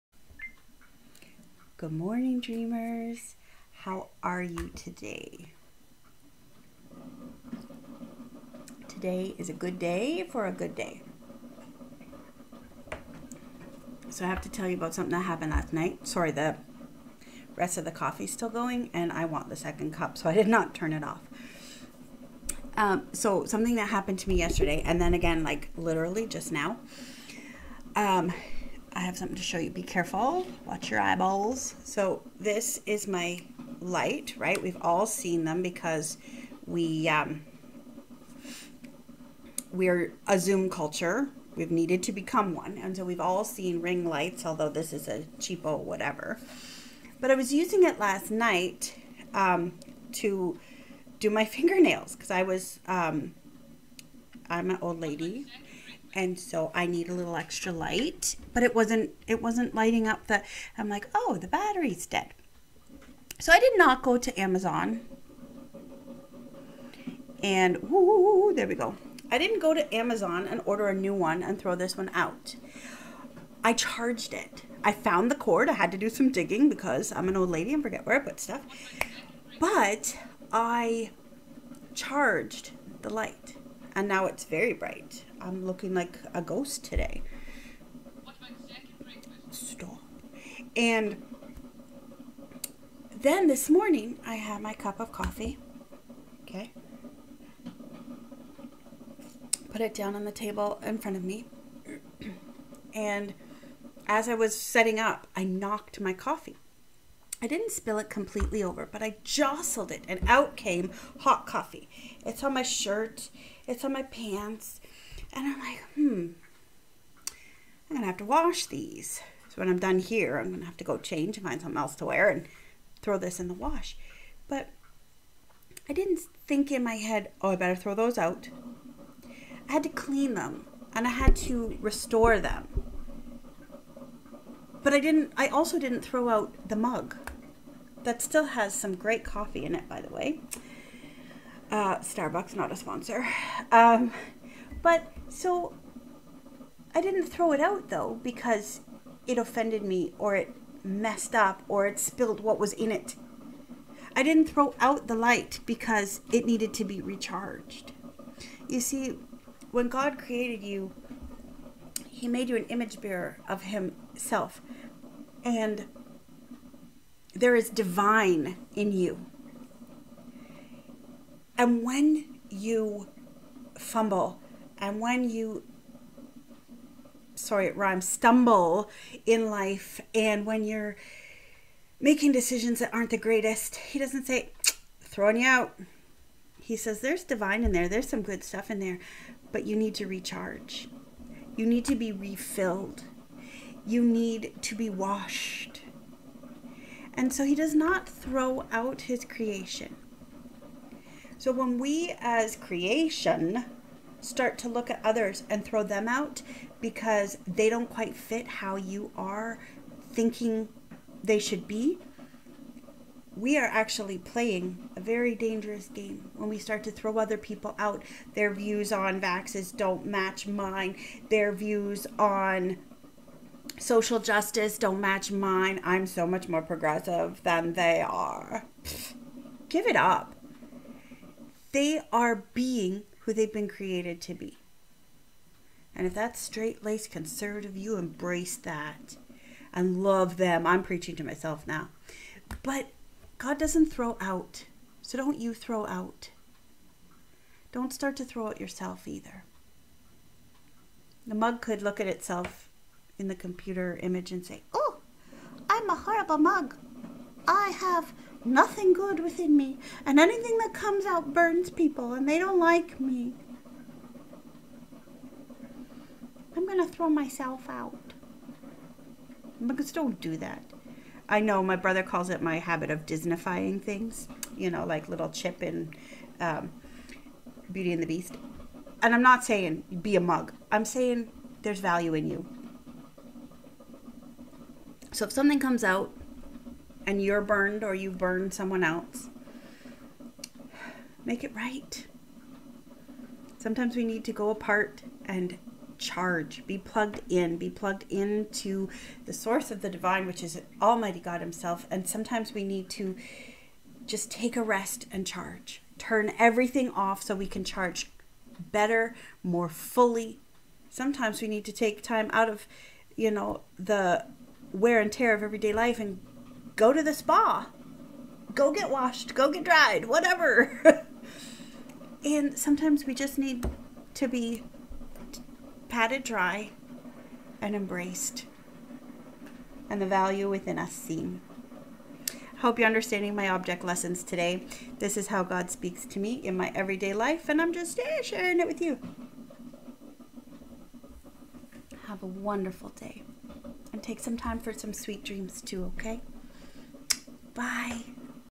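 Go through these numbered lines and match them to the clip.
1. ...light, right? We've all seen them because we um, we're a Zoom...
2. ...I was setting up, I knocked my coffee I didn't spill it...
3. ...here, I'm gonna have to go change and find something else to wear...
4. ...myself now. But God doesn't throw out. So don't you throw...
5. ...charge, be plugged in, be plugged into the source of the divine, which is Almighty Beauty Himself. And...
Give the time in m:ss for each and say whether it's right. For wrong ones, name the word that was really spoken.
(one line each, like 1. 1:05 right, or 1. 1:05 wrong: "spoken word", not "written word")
1. 0:33 right
2. 1:44 right
3. 1:59 right
4. 4:01 right
5. 4:55 wrong: "God", not "Beauty".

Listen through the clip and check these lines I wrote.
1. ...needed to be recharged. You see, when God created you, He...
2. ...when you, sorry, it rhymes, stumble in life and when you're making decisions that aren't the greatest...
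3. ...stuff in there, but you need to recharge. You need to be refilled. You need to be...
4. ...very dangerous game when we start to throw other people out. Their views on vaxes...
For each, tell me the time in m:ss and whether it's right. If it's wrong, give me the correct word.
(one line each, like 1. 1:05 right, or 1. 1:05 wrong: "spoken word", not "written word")
1. 2:36 right
2. 2:54 right
3. 3:08 right
4. 3:34 right.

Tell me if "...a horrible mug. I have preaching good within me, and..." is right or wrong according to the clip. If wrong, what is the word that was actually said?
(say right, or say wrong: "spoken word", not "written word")
wrong: "nothing", not "preaching".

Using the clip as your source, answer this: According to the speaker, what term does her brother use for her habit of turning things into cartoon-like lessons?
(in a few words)
Disneyfying.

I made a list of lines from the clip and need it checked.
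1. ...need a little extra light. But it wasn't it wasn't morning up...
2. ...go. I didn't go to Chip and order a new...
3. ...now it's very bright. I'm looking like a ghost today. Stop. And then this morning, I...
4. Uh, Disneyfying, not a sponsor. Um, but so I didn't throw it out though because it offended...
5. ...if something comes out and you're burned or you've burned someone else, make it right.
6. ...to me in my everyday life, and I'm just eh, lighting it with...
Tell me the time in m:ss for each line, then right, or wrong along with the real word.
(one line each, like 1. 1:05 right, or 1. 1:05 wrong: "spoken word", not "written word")
1. 0:56 wrong: "lighting", not "morning"
2. 1:08 wrong: "Amazon", not "Chip"
3. 1:24 right
4. 2:21 wrong: "Starbucks", not "Disneyfying"
5. 4:45 right
6. 5:36 wrong: "sharing", not "lighting".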